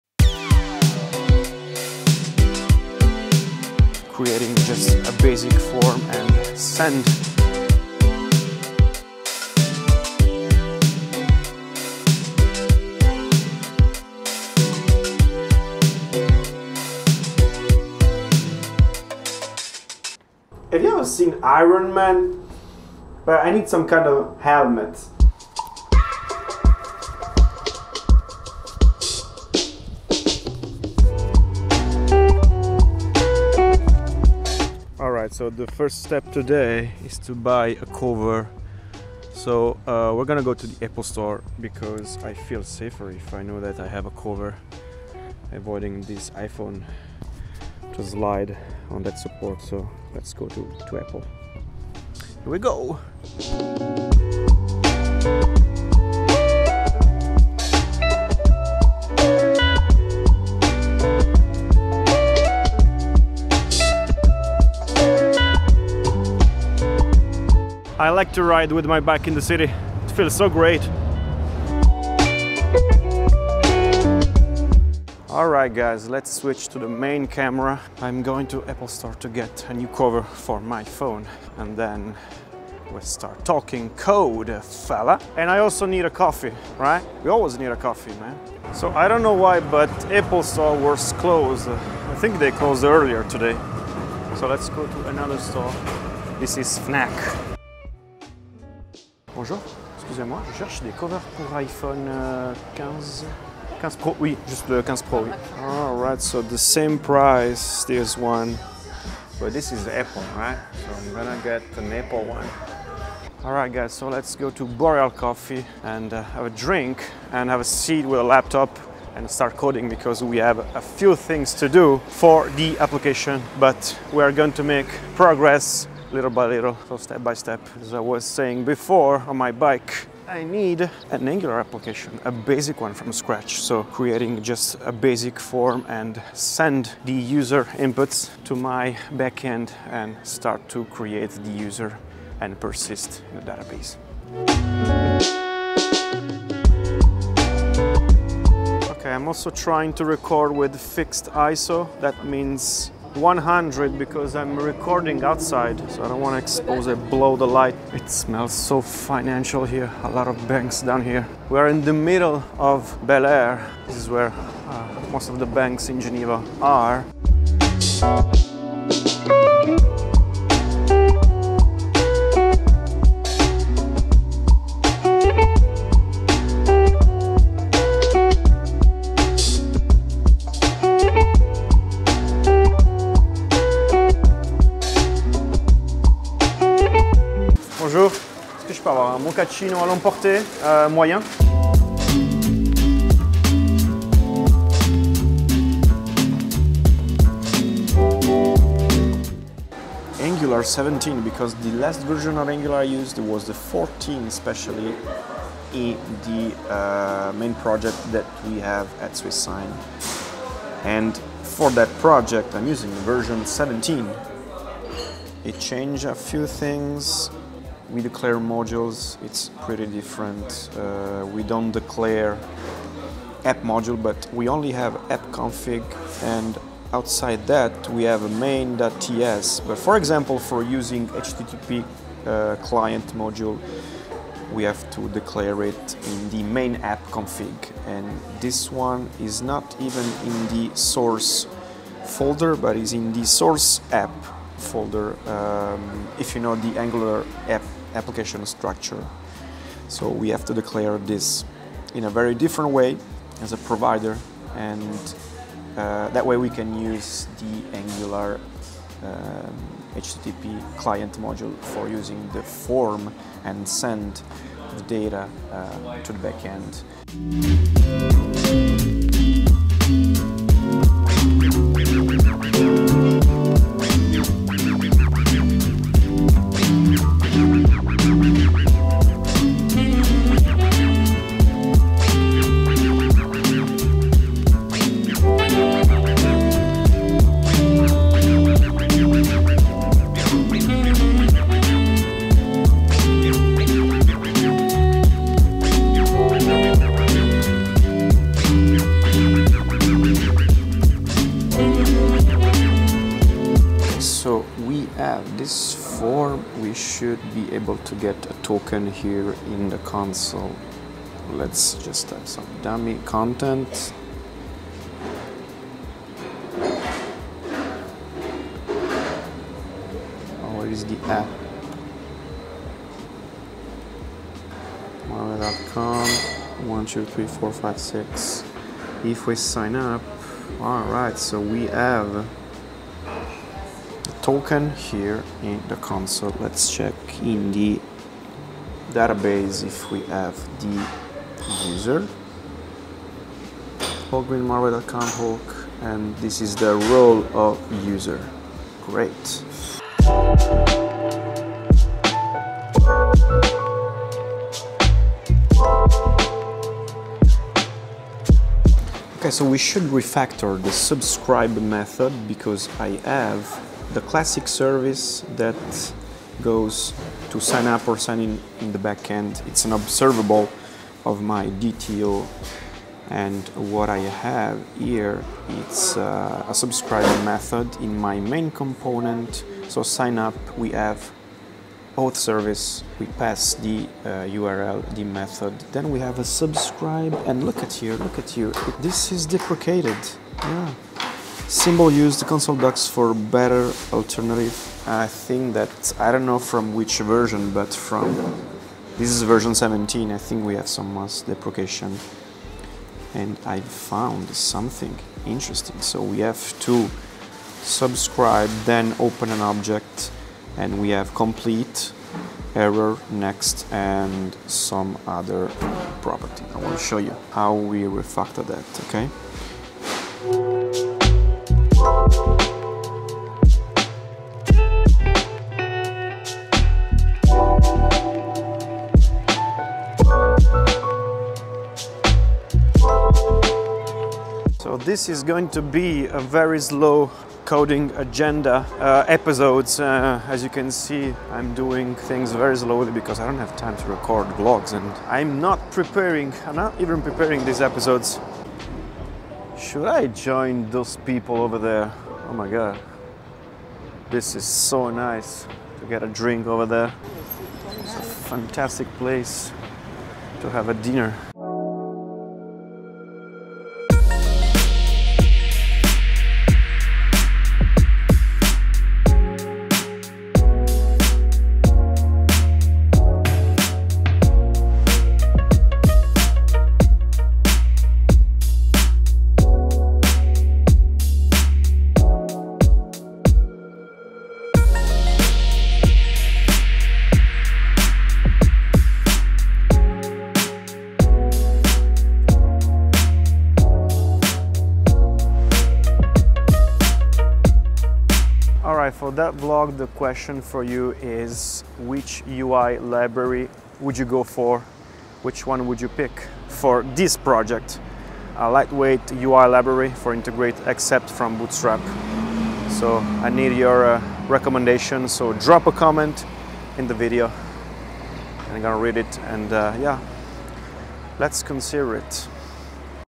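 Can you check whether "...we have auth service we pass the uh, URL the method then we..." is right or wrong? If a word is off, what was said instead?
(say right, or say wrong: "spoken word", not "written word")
right.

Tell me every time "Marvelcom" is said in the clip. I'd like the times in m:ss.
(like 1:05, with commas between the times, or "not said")
5:25.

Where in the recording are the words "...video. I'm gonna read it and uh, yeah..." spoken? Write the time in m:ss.
8:36.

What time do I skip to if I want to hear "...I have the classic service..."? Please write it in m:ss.
6:02.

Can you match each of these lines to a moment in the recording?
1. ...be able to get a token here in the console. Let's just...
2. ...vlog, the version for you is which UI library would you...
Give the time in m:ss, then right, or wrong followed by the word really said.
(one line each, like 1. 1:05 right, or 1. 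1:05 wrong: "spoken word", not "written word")
1. 5:07 right
2. 8:19 wrong: "question", not "version".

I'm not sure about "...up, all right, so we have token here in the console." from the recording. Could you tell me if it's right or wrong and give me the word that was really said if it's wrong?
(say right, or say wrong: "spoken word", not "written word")
right.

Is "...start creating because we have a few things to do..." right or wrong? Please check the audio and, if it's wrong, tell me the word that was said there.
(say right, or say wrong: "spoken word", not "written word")
wrong: "coding", not "creating".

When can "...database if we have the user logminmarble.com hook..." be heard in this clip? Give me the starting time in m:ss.
5:38.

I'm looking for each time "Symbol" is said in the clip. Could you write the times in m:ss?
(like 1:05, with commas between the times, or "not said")
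6:31.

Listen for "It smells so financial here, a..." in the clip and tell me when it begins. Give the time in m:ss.
2:37.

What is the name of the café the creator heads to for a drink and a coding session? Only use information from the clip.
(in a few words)
Boreal Coffee.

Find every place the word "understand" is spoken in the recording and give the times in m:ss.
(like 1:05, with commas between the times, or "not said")
not said.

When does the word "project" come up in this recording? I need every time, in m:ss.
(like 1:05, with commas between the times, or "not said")
3:27, 3:32, 8:27.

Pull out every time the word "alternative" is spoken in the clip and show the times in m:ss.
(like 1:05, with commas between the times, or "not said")
6:33.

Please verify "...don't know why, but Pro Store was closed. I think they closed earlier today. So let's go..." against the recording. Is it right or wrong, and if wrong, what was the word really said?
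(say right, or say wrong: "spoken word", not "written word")
wrong: "Apple", not "Pro".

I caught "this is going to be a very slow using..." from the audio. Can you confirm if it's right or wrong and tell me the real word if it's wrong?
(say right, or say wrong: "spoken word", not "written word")
wrong: "coding", not "using".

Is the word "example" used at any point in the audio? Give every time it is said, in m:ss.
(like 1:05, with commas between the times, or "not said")
3:49.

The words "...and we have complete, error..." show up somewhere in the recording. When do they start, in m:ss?
6:50.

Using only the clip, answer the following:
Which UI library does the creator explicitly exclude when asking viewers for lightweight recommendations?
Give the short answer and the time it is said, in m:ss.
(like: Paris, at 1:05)
Bootstrap, at 8:31.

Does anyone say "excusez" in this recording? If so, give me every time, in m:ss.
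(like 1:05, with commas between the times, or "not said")
1:39.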